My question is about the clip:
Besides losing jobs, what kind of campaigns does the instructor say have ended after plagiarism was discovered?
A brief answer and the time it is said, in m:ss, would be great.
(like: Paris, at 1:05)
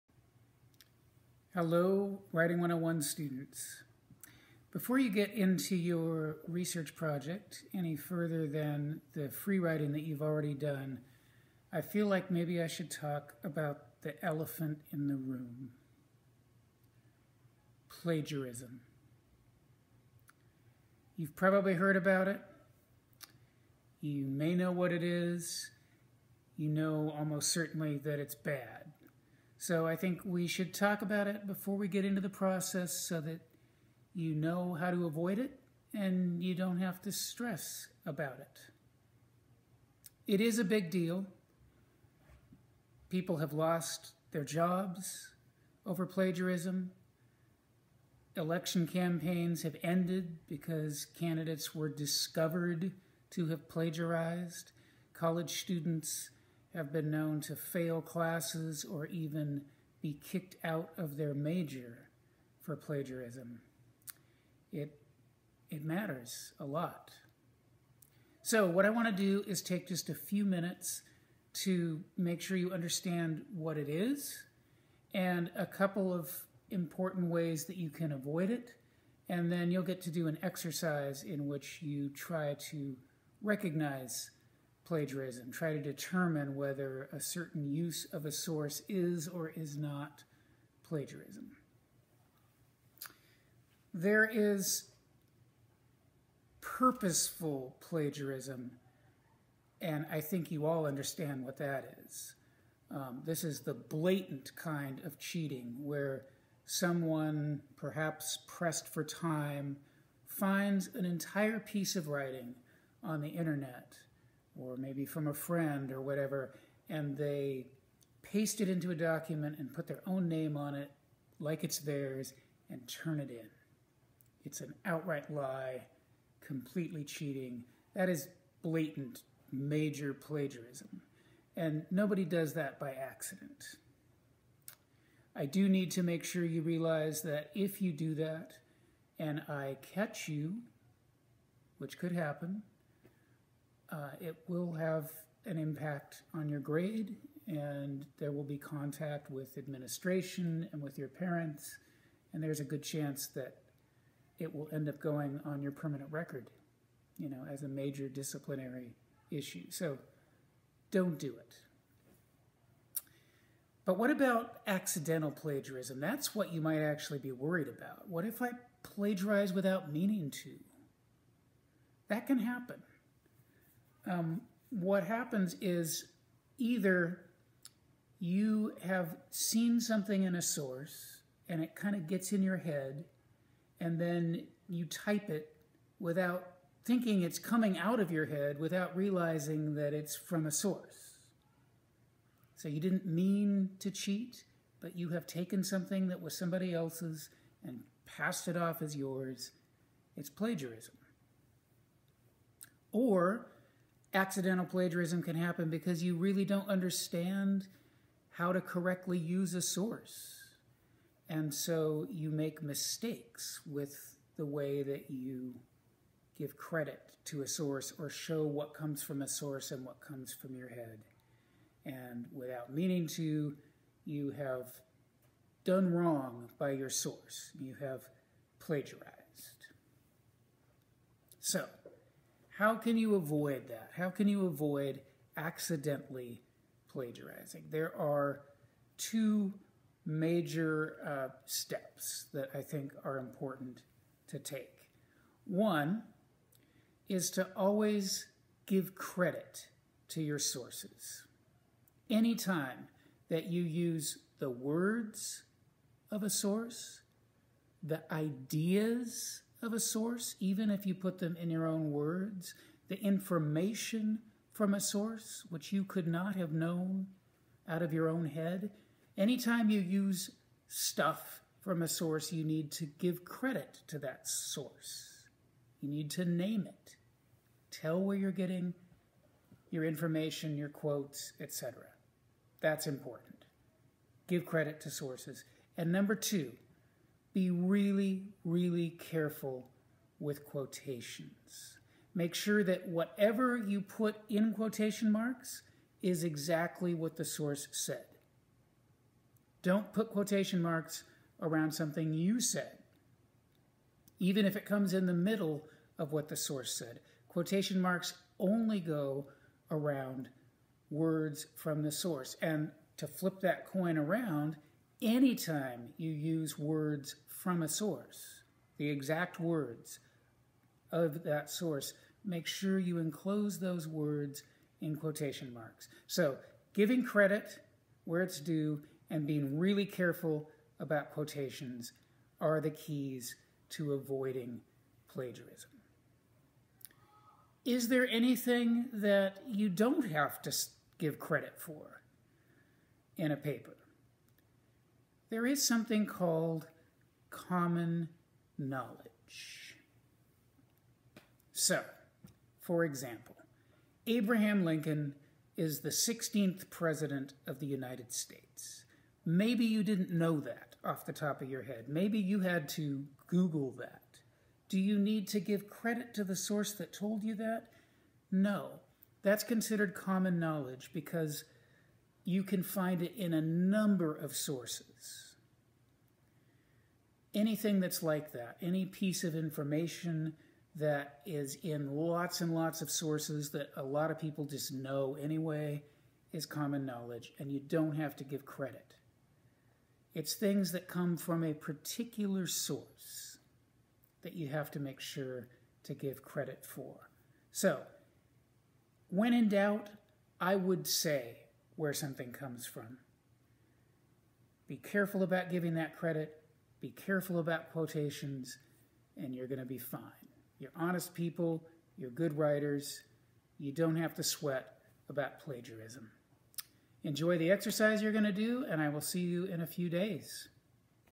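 Election campaigns, at 0:48.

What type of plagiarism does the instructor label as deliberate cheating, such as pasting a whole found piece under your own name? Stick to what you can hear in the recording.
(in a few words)
Purposeful plagiarism.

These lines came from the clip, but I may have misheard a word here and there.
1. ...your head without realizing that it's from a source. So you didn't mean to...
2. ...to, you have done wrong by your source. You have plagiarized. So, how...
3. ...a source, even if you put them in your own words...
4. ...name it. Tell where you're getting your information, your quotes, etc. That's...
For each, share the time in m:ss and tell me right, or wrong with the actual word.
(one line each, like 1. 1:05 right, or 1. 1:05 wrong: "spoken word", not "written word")
1. 3:08 right
2. 3:43 right
3. 4:19 right
4. 4:36 right.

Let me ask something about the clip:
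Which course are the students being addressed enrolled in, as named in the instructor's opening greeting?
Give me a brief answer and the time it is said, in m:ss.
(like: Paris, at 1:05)
Writing 101, at 0:02.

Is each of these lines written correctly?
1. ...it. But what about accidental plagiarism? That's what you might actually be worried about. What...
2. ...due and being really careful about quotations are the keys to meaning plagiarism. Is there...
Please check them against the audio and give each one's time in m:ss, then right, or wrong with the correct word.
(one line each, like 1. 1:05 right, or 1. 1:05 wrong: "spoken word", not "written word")
1. 2:41 right
2. 5:28 wrong: "avoiding", not "meaning".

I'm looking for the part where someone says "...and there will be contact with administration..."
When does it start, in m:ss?
2:27.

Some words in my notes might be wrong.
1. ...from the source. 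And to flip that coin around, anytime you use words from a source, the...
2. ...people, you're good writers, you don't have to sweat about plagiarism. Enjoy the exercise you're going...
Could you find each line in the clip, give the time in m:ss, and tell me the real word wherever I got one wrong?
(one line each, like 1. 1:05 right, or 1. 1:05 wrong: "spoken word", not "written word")
1. 5:11 right
2. 6:51 right.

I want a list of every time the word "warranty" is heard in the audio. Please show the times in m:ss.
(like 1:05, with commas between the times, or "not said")
not said.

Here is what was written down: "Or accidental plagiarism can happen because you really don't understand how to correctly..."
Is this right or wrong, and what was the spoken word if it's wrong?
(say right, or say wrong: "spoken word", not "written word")
right.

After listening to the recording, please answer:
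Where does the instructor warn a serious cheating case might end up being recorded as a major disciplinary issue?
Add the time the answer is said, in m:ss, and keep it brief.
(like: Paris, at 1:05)
Permanent record, at 2:35.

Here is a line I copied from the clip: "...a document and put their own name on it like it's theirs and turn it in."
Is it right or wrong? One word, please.
right.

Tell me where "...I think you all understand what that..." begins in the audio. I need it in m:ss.
1:40.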